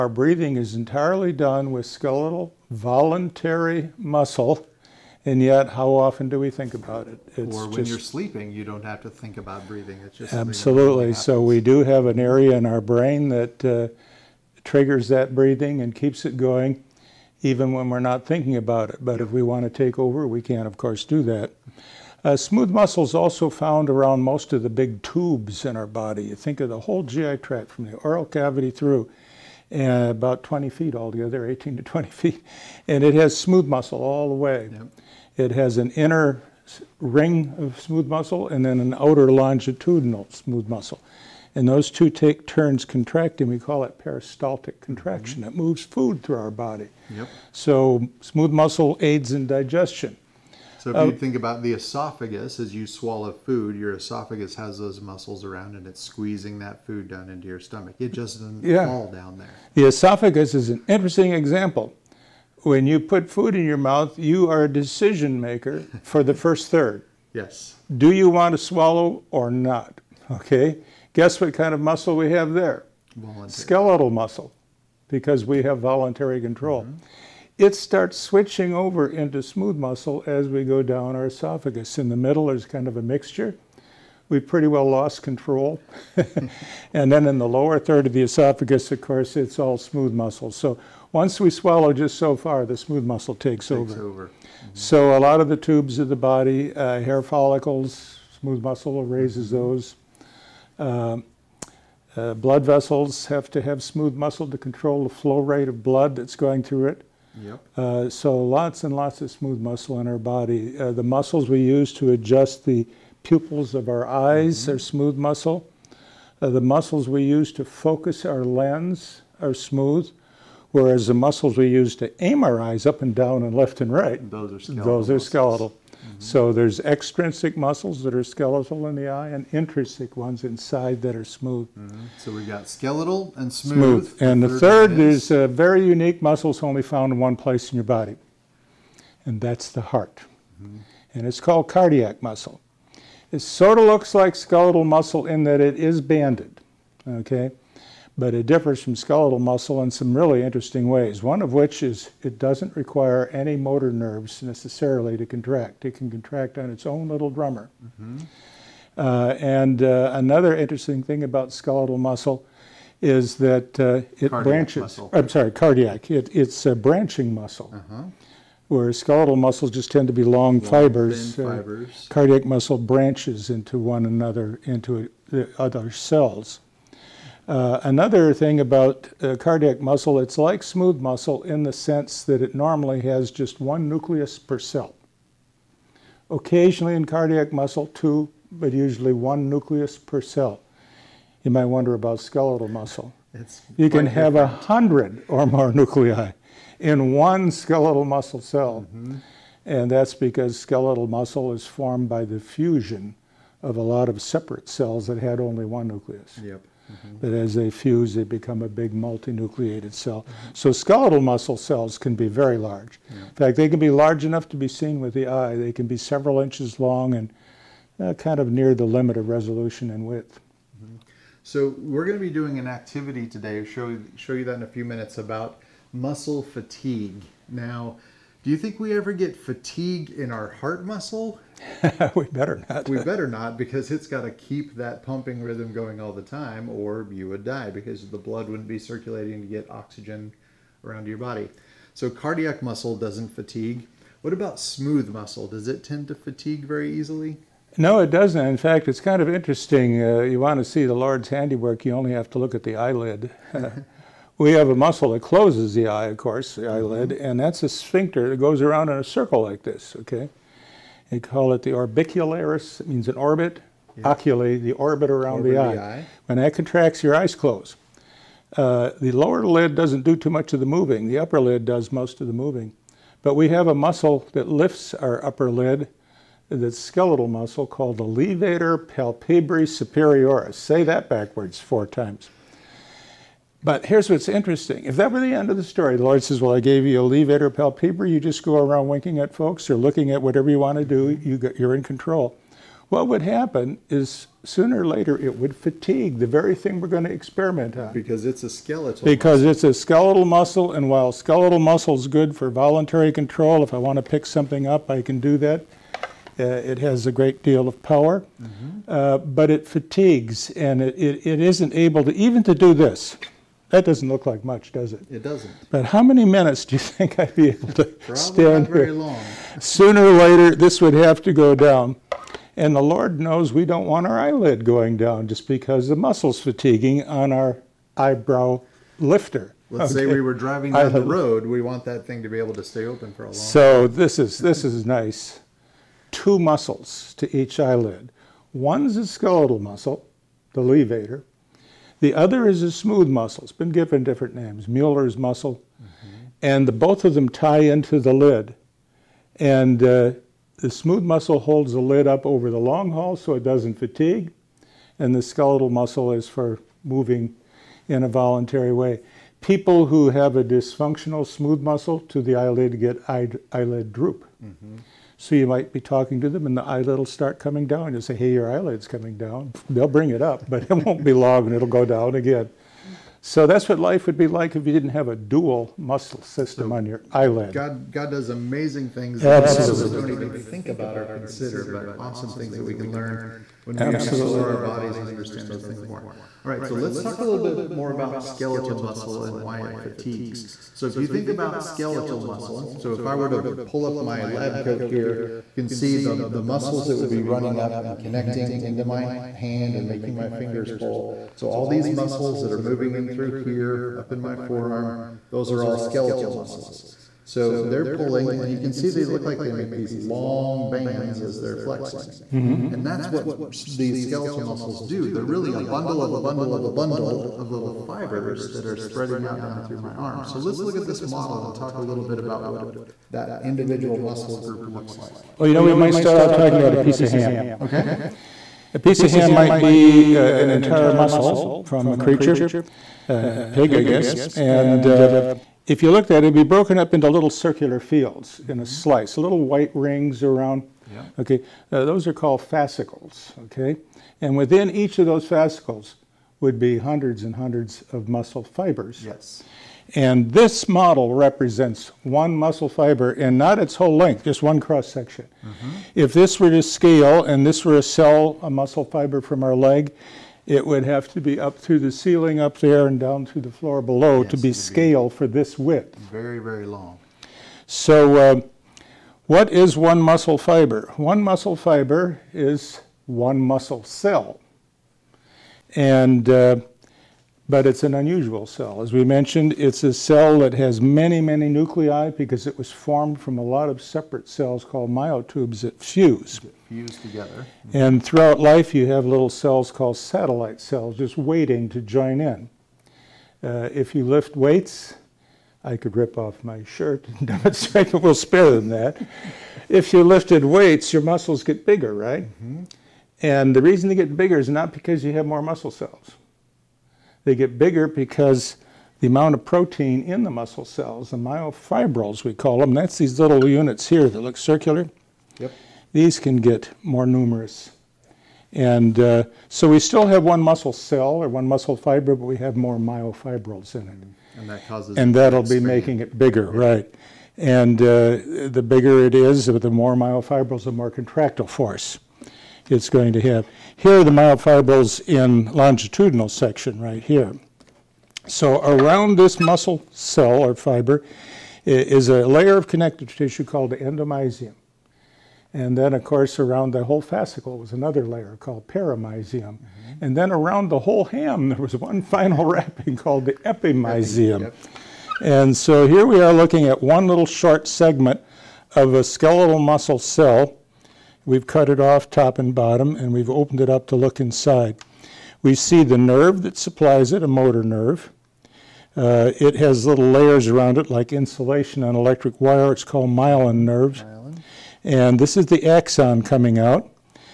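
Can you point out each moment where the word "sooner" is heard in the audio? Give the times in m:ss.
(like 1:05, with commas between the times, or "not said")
4:54, 5:19.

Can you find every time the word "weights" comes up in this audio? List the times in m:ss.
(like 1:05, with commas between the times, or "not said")
8:14, 8:20.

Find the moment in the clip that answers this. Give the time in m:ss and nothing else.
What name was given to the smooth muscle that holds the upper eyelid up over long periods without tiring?
5:44.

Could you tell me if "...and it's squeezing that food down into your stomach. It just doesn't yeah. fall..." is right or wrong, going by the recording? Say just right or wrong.
right.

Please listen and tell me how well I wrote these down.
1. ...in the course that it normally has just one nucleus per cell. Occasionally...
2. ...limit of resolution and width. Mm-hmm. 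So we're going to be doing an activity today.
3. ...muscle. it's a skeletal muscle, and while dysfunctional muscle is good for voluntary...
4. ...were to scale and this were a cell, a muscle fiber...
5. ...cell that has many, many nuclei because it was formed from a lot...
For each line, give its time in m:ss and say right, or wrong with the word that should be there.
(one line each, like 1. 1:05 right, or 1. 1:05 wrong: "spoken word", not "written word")
1. 3:01 wrong: "sense", not "course"
2. 3:38 right
3. 4:59 wrong: "skeletal", not "dysfunctional"
4. 7:36 right
5. 7:59 right.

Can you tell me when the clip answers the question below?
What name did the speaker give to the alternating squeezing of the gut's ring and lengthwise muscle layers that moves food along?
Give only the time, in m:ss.
0:43.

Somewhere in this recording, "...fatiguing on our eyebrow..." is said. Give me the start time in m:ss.
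5:26.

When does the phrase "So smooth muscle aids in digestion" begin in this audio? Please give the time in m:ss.
0:47.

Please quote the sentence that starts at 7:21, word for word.
Okay, uh, those are called fascicles.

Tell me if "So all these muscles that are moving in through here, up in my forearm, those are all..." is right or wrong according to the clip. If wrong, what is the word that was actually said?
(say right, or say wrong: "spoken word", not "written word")
right.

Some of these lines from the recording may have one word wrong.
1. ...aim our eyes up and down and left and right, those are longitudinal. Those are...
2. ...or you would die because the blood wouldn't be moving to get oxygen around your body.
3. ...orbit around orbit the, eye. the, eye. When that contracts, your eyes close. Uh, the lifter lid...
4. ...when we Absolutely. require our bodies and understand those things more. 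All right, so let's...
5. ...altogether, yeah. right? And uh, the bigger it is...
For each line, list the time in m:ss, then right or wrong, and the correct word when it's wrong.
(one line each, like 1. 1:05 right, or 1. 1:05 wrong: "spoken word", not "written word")
1. 2:02 wrong: "skeletal", not "longitudinal"
2. 3:56 wrong: "circulating", not "moving"
3. 4:24 wrong: "lower", not "lifter"
4. 6:23 wrong: "explore", not "require"
5. 8:46 wrong: "bigger", not "altogether".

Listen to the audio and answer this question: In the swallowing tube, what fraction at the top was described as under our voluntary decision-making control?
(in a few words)
the first third.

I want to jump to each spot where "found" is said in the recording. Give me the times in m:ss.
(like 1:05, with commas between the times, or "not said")
0:23, 2:16.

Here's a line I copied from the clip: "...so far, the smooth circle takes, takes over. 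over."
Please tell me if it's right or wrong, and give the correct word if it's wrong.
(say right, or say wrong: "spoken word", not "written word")
wrong: "muscle", not "circle".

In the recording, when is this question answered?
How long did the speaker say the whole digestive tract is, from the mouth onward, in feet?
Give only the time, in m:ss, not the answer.
0:31.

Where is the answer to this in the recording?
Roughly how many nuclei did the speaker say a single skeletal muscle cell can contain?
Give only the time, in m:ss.
3:14.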